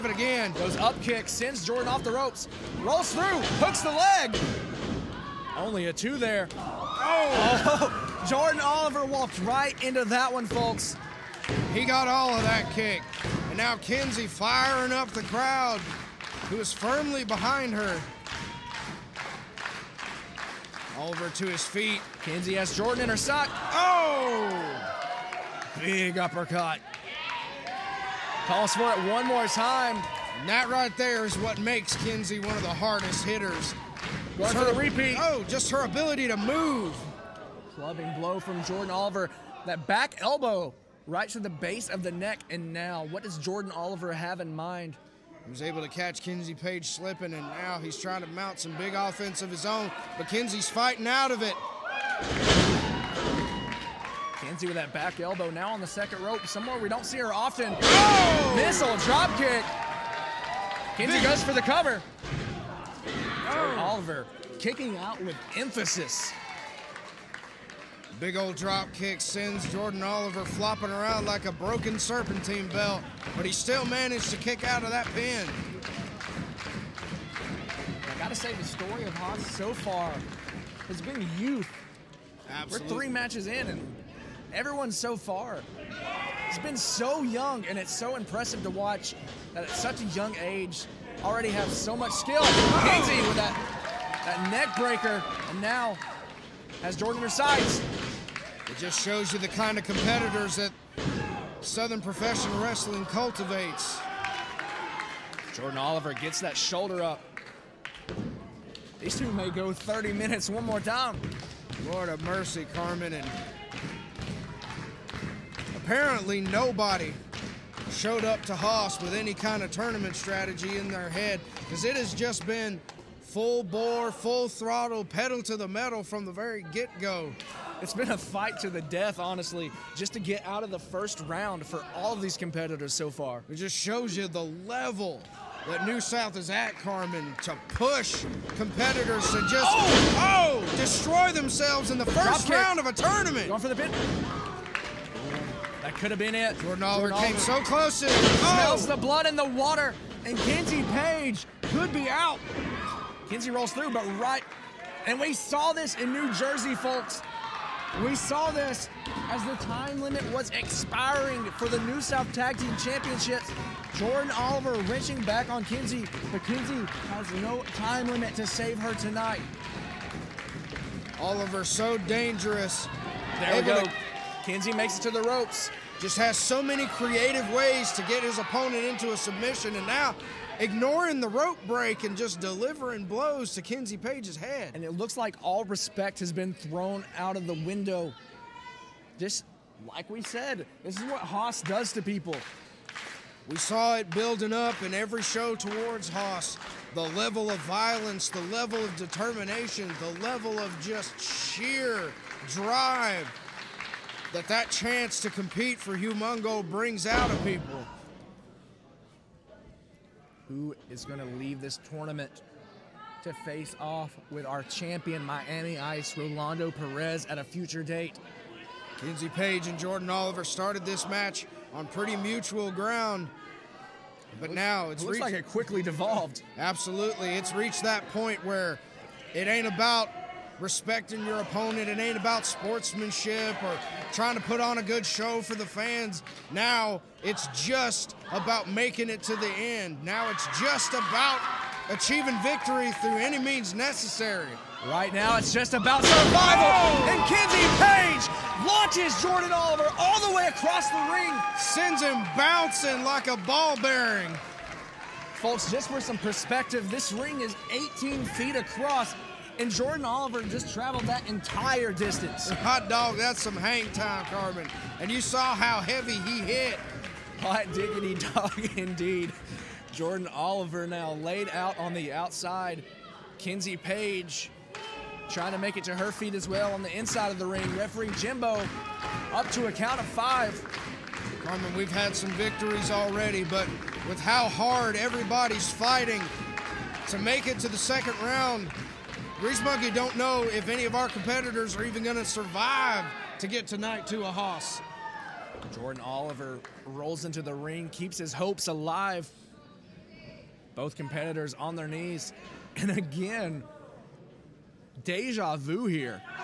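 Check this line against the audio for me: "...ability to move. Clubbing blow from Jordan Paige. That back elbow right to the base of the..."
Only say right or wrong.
wrong.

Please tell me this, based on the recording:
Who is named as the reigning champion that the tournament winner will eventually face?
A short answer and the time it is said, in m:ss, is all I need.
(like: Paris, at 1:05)
Rolando Perez, at 3:36.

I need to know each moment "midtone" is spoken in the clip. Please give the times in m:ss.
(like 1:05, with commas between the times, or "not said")
not said.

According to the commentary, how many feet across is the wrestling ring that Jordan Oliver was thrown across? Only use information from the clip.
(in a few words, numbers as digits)
18.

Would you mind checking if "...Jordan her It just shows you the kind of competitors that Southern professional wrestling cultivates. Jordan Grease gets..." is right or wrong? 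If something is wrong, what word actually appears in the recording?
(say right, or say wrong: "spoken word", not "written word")
wrong: "Oliver", not "Grease".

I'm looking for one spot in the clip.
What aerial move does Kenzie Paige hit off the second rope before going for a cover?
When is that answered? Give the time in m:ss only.
0:58.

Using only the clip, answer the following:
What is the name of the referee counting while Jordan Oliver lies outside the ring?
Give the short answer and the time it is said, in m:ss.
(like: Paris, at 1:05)
Jimbo, at 4:38.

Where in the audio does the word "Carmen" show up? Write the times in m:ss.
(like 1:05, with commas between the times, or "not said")
1:52, 2:16, 4:24, 4:41.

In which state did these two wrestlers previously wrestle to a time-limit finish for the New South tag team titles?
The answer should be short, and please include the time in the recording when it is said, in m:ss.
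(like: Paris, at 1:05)
New Jersey, at 2:36.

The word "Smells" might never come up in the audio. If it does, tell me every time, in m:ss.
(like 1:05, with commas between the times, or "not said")
2:28.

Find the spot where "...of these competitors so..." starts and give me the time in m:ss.
2:12.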